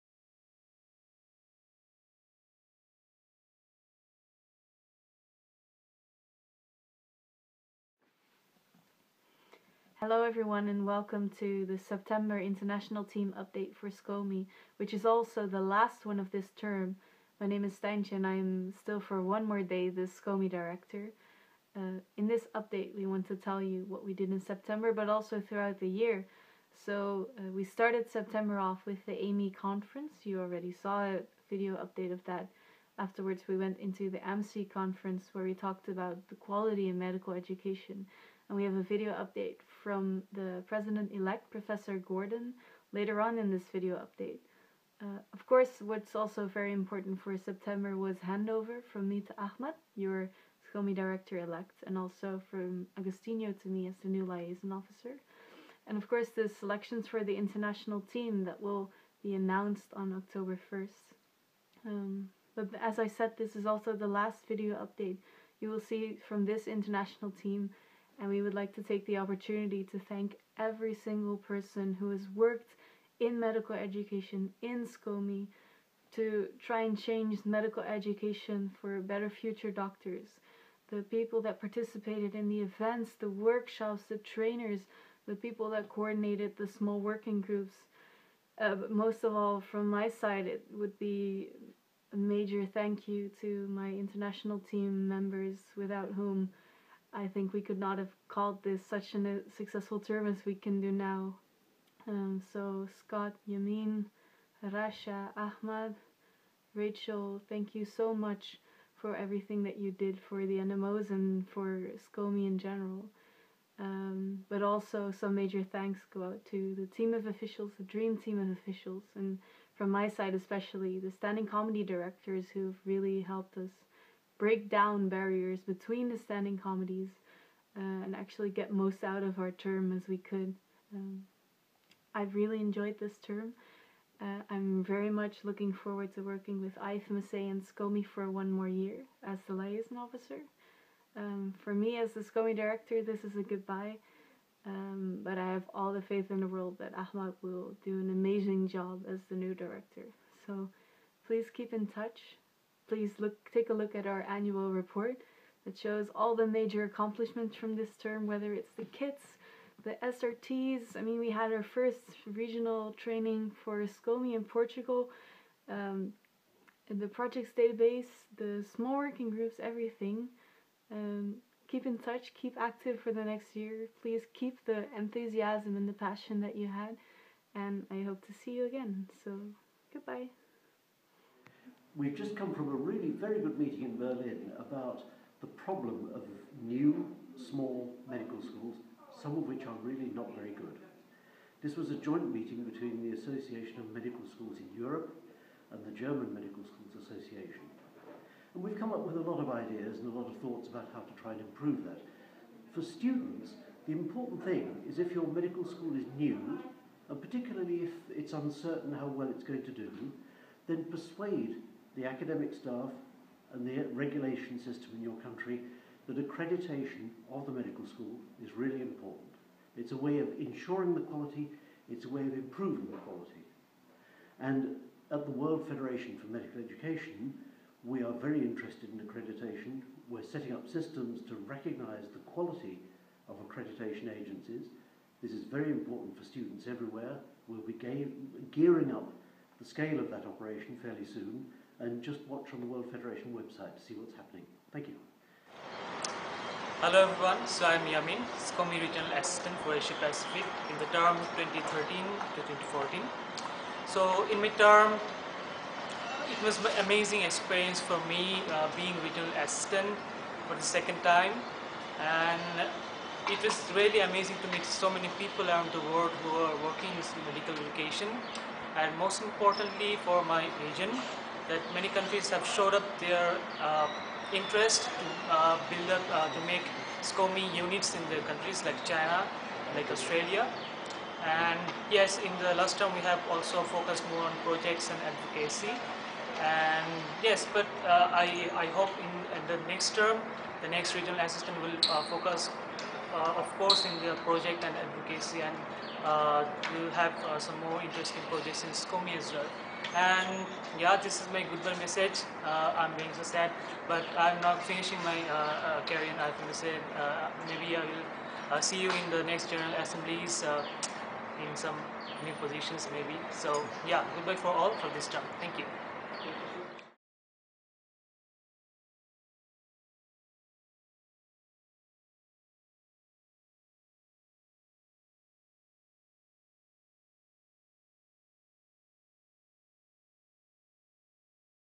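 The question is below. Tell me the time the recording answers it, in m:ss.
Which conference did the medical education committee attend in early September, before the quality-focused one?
0:29.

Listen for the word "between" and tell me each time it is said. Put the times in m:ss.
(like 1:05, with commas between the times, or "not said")
2:05, 3:12.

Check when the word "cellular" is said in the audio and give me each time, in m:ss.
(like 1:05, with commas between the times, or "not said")
not said.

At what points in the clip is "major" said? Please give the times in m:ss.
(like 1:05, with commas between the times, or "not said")
1:32, 1:55, 2:36.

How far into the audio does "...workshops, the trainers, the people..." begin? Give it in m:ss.
1:23.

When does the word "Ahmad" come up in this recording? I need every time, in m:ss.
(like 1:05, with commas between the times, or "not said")
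0:49, 1:45, 2:26.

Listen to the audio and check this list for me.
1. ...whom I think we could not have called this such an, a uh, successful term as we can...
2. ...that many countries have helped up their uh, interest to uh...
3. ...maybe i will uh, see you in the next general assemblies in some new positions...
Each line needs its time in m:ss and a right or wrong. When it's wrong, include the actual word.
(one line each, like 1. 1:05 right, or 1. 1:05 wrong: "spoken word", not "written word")
1. 1:36 right
2. 4:31 wrong: "showed", not "helped"
3. 5:07 right.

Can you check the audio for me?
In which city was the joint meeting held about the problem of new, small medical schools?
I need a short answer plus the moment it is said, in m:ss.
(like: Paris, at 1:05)
Berlin, at 3:03.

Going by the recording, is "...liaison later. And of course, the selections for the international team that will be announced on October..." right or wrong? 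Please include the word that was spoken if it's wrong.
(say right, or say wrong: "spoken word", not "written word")
wrong: "officer", not "later".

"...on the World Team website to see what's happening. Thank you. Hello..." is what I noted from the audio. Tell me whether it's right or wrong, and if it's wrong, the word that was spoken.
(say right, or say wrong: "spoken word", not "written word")
wrong: "Federation", not "Team".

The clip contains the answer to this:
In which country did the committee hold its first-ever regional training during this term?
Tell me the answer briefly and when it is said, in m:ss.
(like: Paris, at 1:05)
Portugal, at 2:44.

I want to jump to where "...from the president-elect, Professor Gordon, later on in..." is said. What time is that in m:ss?
0:39.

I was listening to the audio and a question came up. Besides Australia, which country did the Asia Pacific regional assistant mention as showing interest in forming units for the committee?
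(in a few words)
China.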